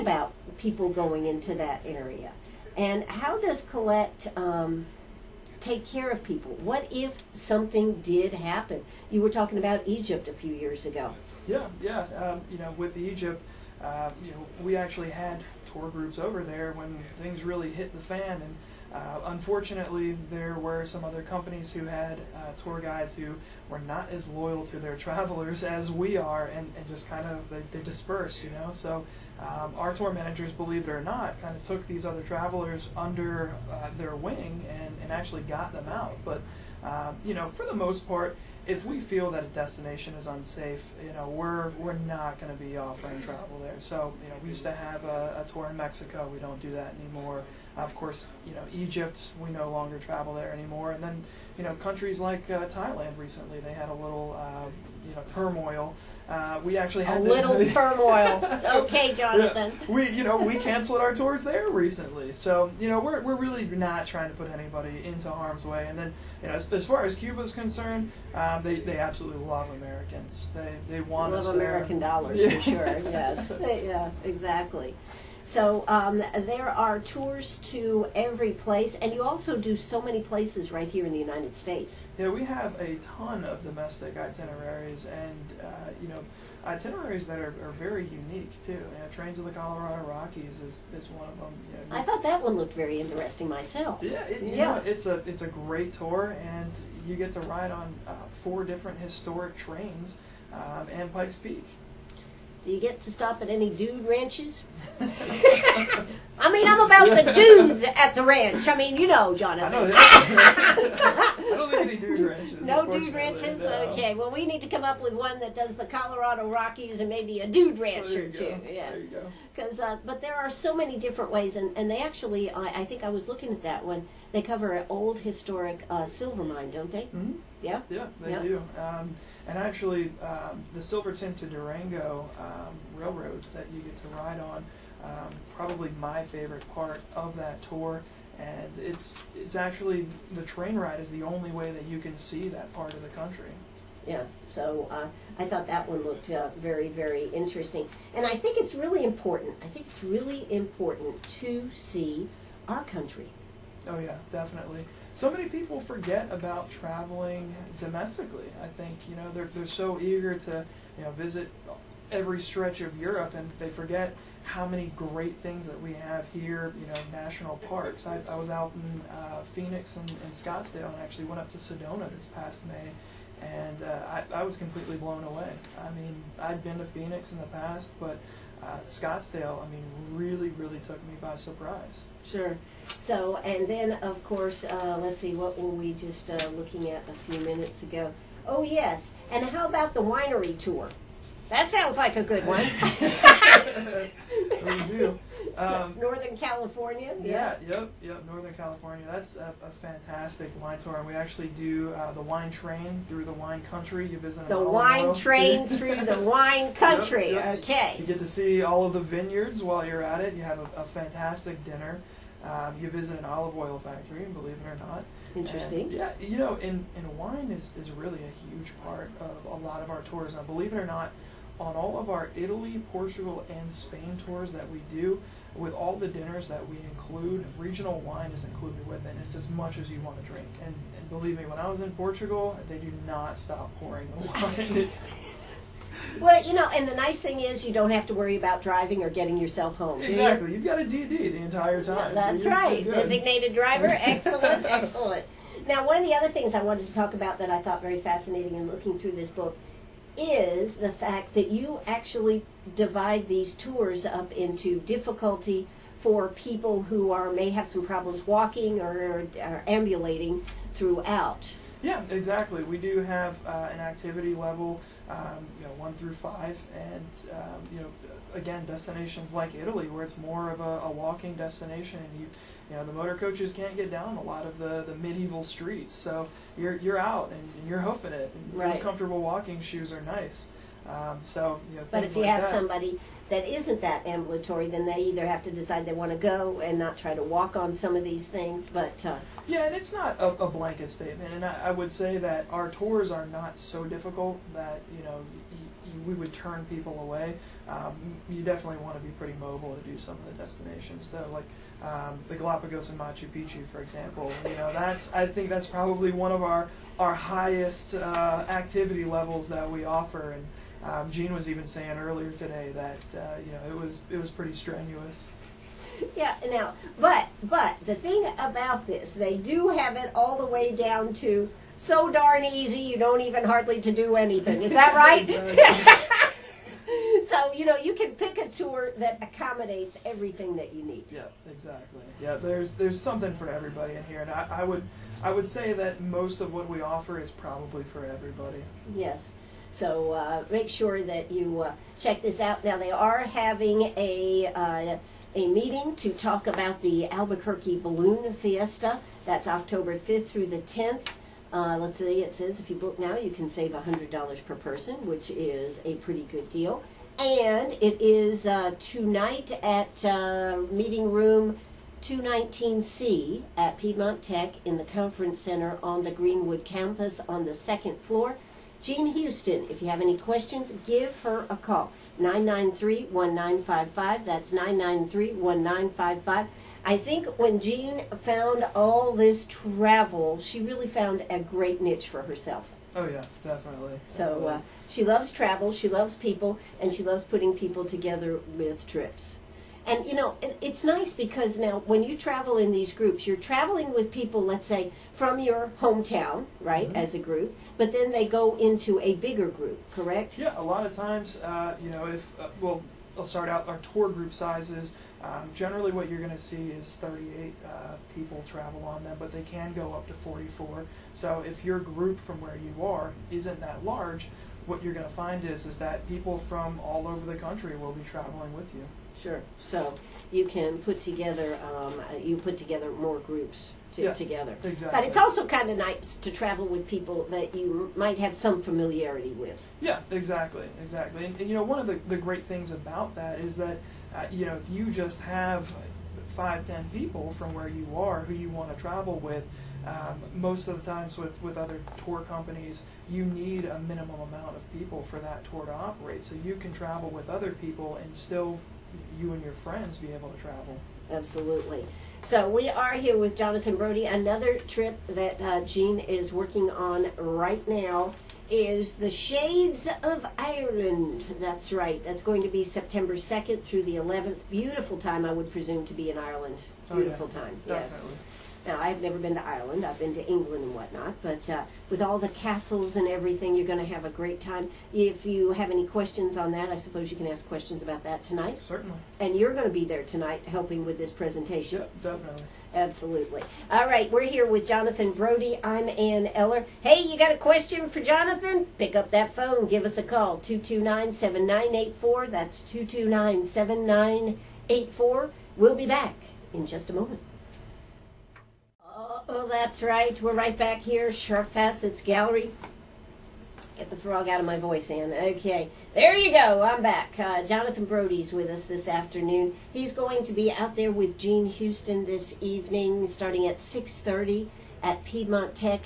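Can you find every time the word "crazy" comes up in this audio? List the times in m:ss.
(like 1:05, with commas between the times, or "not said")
not said.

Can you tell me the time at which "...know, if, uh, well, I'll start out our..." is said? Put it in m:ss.
6:41.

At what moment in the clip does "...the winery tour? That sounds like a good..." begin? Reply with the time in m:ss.
3:09.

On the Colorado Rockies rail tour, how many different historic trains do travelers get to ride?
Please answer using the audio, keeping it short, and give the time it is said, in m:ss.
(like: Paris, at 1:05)
4, at 1:38.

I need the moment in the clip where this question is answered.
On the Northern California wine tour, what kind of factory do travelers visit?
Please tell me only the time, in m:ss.
3:33.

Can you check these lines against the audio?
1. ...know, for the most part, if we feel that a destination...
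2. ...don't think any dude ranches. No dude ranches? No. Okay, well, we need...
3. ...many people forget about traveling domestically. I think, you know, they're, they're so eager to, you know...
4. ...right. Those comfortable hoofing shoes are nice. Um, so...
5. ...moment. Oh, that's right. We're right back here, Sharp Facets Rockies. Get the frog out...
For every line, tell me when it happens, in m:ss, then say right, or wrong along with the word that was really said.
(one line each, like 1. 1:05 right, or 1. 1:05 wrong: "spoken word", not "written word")
1. 0:37 right
2. 1:51 right
3. 2:35 right
4. 4:38 wrong: "walking", not "hoofing"
5. 8:16 wrong: "Gallery", not "Rockies".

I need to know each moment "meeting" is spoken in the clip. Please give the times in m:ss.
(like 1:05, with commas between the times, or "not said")
5:45, 6:00.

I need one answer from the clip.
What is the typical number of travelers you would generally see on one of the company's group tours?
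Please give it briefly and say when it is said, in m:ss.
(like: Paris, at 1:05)
38, at 6:46.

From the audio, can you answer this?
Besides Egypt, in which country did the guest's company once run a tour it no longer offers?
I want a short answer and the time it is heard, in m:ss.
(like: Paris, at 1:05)
Mexico, at 0:45.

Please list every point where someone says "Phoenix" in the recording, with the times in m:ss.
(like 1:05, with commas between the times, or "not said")
2:49, 2:56.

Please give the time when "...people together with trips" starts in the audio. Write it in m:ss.
6:27.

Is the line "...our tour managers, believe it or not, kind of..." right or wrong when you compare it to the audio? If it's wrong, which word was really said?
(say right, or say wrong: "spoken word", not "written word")
right.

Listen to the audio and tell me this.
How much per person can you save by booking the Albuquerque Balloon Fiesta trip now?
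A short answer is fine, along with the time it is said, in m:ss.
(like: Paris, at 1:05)
$100, at 5:53.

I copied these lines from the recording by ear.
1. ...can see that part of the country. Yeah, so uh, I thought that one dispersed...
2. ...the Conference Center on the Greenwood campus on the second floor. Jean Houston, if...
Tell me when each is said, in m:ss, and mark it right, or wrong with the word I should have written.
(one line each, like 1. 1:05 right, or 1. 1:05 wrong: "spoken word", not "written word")
1. 2:21 wrong: "looked", not "dispersed"
2. 6:04 right.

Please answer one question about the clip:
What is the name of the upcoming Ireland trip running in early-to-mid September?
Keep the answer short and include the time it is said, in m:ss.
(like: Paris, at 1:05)
Shades of Ireland, at 7:39.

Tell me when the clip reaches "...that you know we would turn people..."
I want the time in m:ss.
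4:54.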